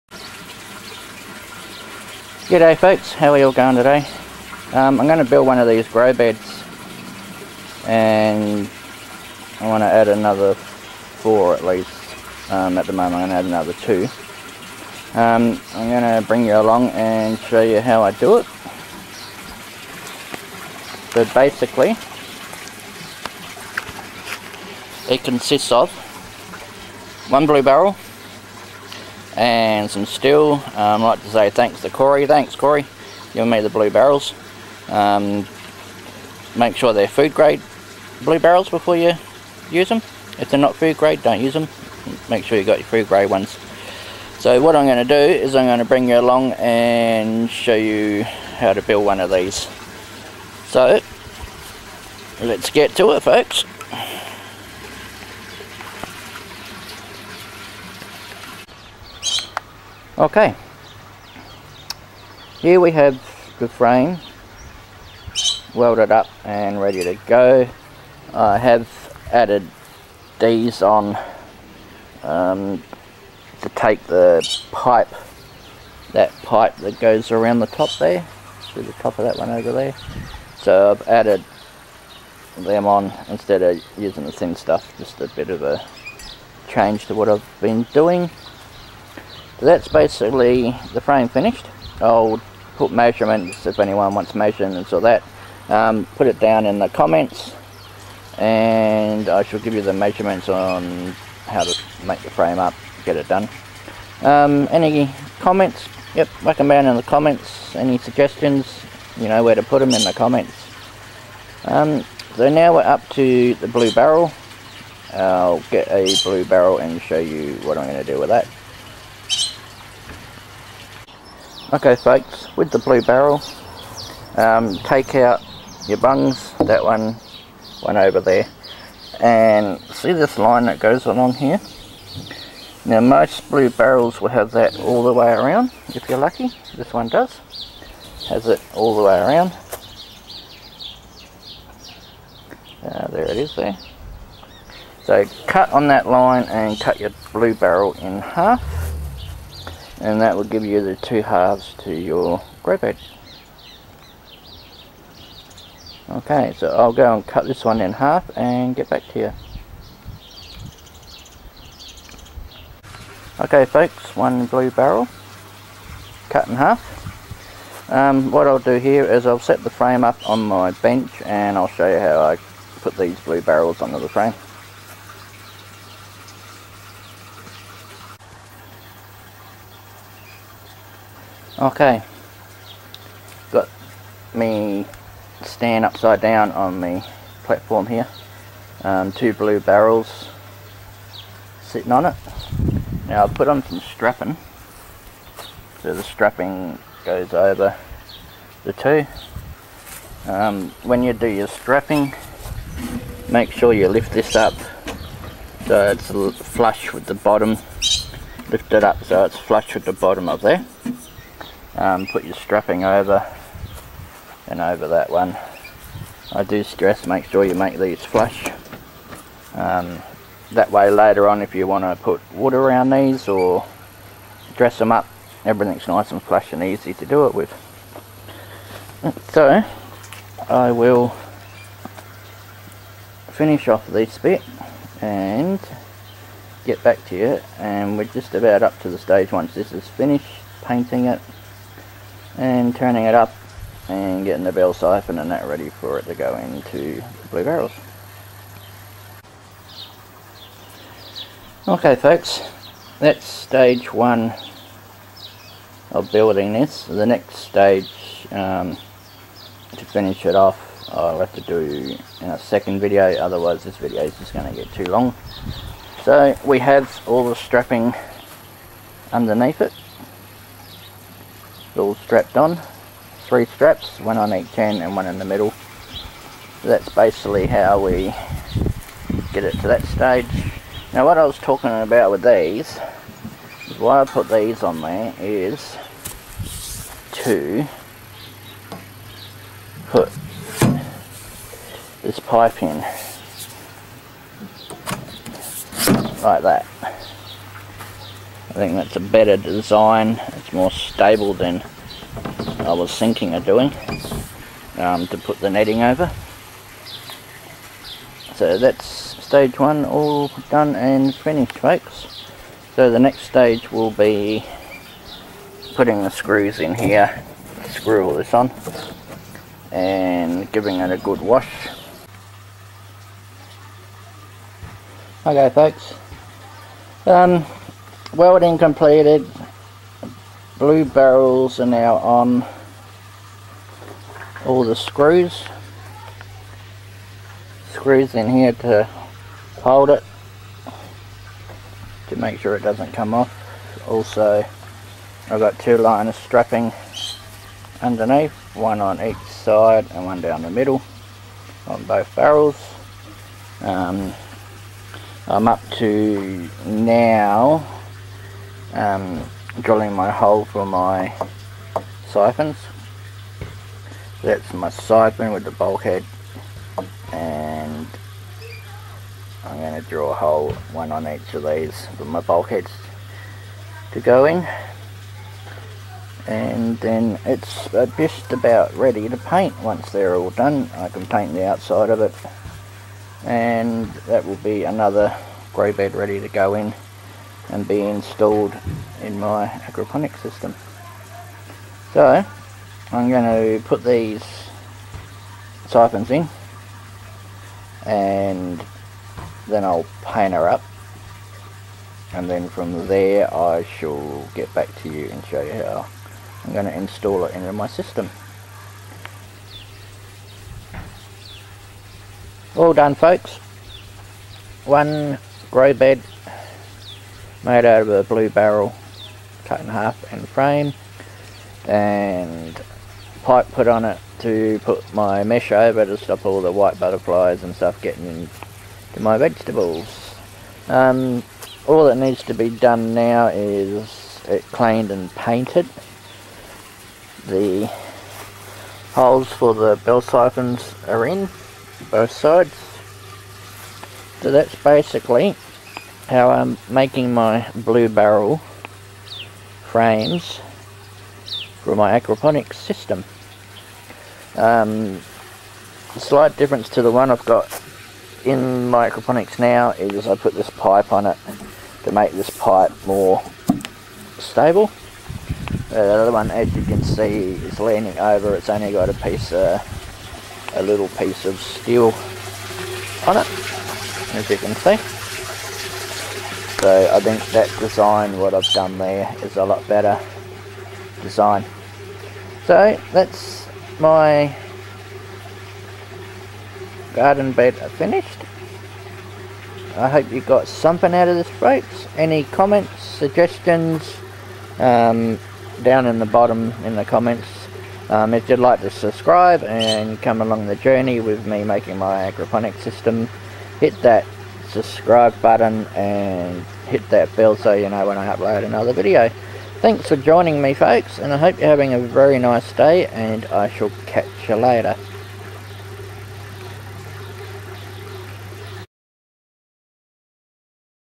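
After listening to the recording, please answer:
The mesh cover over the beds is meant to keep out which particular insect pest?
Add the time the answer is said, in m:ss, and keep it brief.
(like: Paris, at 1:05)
White butterflies, at 7:06.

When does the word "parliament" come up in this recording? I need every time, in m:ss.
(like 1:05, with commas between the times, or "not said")
not said.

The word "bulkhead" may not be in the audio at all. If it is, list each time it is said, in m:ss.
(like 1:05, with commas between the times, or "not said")
6:05, 6:12.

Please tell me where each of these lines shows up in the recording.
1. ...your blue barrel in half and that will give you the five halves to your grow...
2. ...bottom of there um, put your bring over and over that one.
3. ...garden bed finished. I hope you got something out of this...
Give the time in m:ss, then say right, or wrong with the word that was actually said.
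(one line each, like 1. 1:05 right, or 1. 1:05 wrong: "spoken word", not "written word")
1. 2:26 wrong: "two", not "five"
2. 3:29 wrong: "strapping", not "bring"
3. 8:06 right.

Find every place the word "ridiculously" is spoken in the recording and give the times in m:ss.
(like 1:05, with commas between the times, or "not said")
not said.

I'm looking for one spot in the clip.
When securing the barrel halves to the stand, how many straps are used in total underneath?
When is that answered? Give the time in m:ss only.
4:33.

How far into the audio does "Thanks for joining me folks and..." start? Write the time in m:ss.
8:29.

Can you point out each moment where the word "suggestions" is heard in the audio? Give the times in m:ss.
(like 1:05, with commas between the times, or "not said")
1:47, 8:12.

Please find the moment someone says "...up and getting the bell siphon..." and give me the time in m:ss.
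4:03.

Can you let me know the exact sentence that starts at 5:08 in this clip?
So that's stage one all done and finished folks.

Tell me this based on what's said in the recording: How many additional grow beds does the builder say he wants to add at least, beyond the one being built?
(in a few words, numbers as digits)
4.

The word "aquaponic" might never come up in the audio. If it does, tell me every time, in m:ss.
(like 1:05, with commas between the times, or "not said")
6:29, 7:31, 7:38, 8:22.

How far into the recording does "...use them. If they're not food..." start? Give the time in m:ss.
0:39.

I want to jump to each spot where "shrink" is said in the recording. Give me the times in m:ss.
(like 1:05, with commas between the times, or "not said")
not said.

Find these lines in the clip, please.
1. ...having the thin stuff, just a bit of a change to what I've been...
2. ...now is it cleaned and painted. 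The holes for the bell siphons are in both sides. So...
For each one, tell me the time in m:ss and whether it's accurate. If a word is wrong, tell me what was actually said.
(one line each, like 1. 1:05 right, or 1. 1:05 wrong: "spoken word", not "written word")
1. 1:23 wrong: "using", not "having"
2. 7:12 right.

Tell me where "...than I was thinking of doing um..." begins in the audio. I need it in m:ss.
5:01.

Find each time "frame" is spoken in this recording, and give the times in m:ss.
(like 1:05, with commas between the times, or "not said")
1:03, 1:31, 1:42, 2:49, 2:54, 7:00, 7:29.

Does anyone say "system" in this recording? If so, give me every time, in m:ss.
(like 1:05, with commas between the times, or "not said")
6:30, 6:47, 7:32, 8:22.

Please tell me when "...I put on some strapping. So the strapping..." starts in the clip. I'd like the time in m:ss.
3:13.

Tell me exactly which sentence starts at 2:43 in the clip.
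Okay folks, one blue barrel, cut in half.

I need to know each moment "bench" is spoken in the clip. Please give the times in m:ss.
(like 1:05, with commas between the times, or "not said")
2:50.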